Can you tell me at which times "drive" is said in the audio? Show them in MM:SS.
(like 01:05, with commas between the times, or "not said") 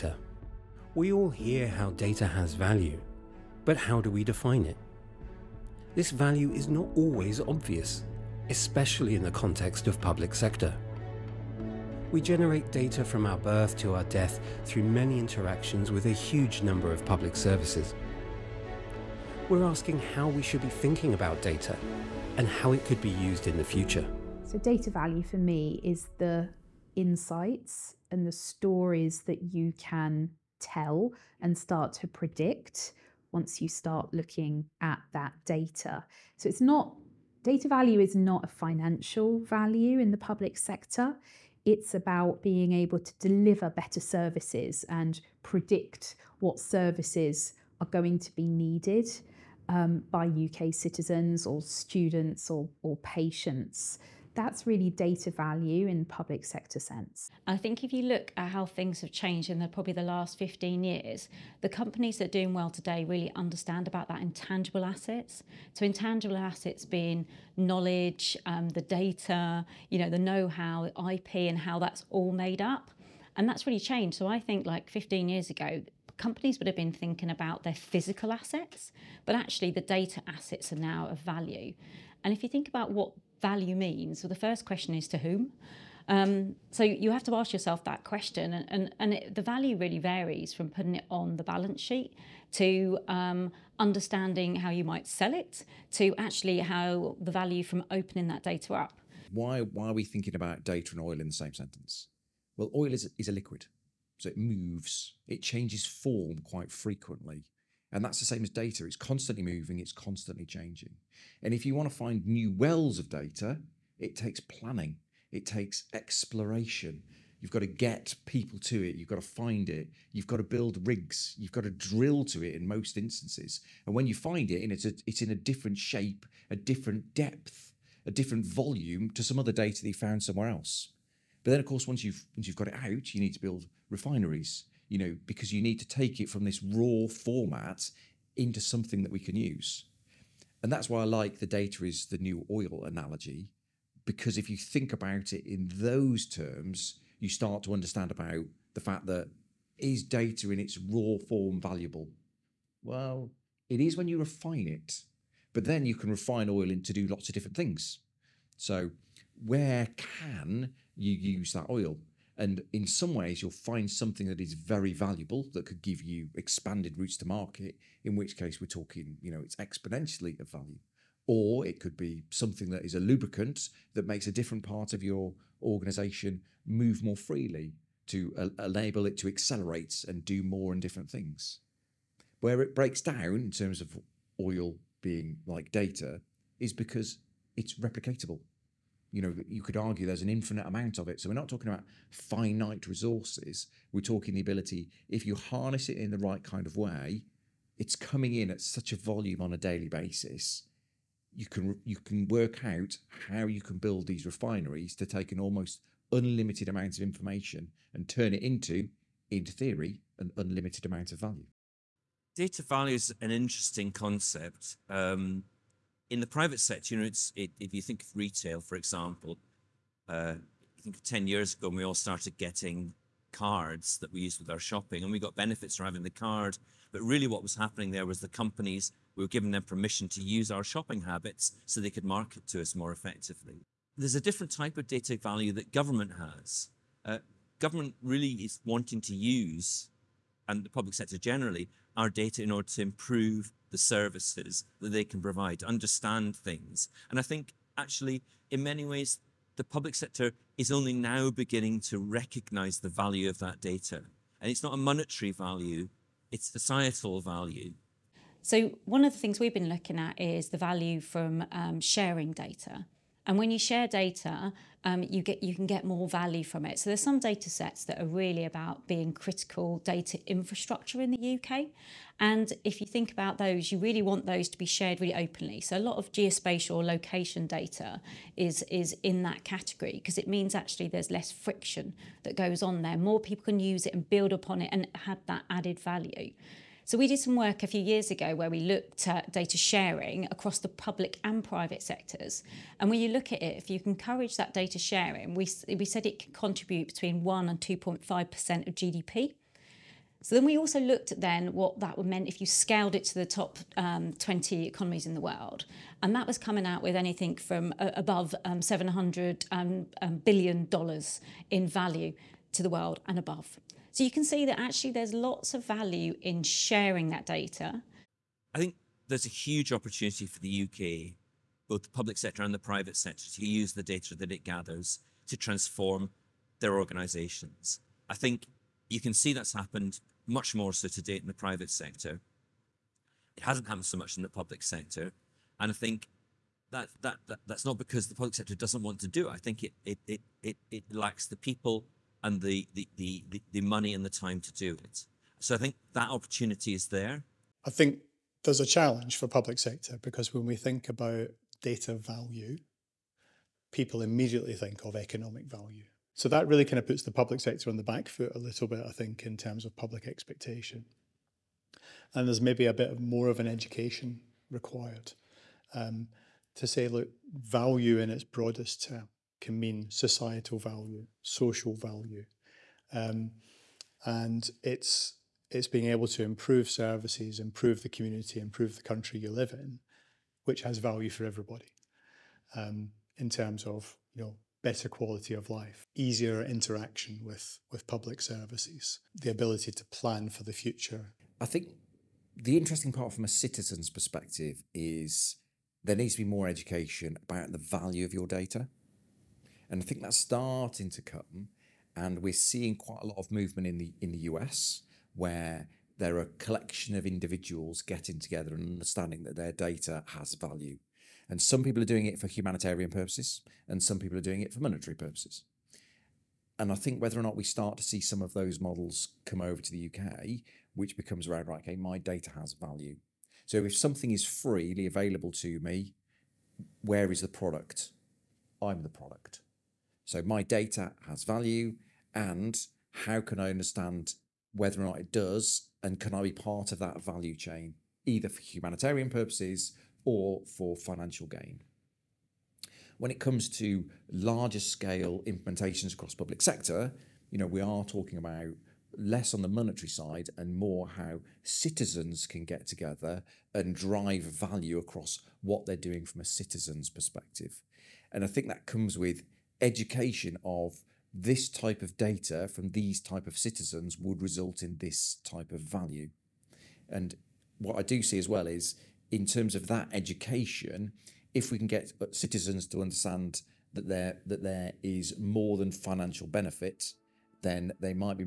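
07:33.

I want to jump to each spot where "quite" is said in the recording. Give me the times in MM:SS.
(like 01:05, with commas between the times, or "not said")
01:46, 06:42.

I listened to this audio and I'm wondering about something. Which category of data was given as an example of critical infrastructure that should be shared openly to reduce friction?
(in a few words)
Geospatial location data.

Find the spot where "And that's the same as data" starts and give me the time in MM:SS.
01:47.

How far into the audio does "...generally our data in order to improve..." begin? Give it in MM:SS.
04:01.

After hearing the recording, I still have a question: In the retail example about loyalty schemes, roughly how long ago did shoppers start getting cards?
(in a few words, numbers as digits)
Ten years ago.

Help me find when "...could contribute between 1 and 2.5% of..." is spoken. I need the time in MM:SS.
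04:56.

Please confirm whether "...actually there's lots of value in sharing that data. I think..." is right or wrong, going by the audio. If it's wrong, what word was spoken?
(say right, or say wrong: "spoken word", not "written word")
right.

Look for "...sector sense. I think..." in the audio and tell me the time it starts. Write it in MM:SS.
00:56.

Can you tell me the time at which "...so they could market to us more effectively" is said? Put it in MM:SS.
03:51.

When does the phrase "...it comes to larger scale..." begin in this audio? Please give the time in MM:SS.
07:23.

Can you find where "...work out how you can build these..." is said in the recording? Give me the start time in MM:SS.
03:22.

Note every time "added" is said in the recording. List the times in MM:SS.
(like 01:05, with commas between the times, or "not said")
04:45.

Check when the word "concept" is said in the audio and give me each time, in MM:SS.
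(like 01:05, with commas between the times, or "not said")
03:33.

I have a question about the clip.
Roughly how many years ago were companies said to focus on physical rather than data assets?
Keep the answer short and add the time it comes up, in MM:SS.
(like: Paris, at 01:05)
15 years, at 01:14.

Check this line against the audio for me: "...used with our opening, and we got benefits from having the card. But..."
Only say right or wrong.
wrong.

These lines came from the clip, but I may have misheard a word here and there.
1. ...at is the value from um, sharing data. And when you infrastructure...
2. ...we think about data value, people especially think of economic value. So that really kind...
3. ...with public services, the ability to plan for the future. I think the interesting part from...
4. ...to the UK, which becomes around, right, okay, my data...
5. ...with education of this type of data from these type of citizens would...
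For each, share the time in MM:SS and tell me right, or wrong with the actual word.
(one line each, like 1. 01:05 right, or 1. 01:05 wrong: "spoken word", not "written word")
1. 04:19 wrong: "share", not "infrastructure"
2. 05:50 wrong: "immediately", not "especially"
3. 06:27 right
4. 06:59 right
5. 07:38 right.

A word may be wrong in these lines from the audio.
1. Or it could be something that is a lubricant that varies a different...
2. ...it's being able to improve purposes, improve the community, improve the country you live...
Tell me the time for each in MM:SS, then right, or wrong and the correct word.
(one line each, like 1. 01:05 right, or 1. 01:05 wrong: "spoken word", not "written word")
1. 02:51 wrong: "makes", not "varies"
2. 06:15 wrong: "services", not "purposes".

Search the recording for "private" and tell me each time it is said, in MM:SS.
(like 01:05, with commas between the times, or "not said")
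03:36, 04:51, 05:22, 05:31.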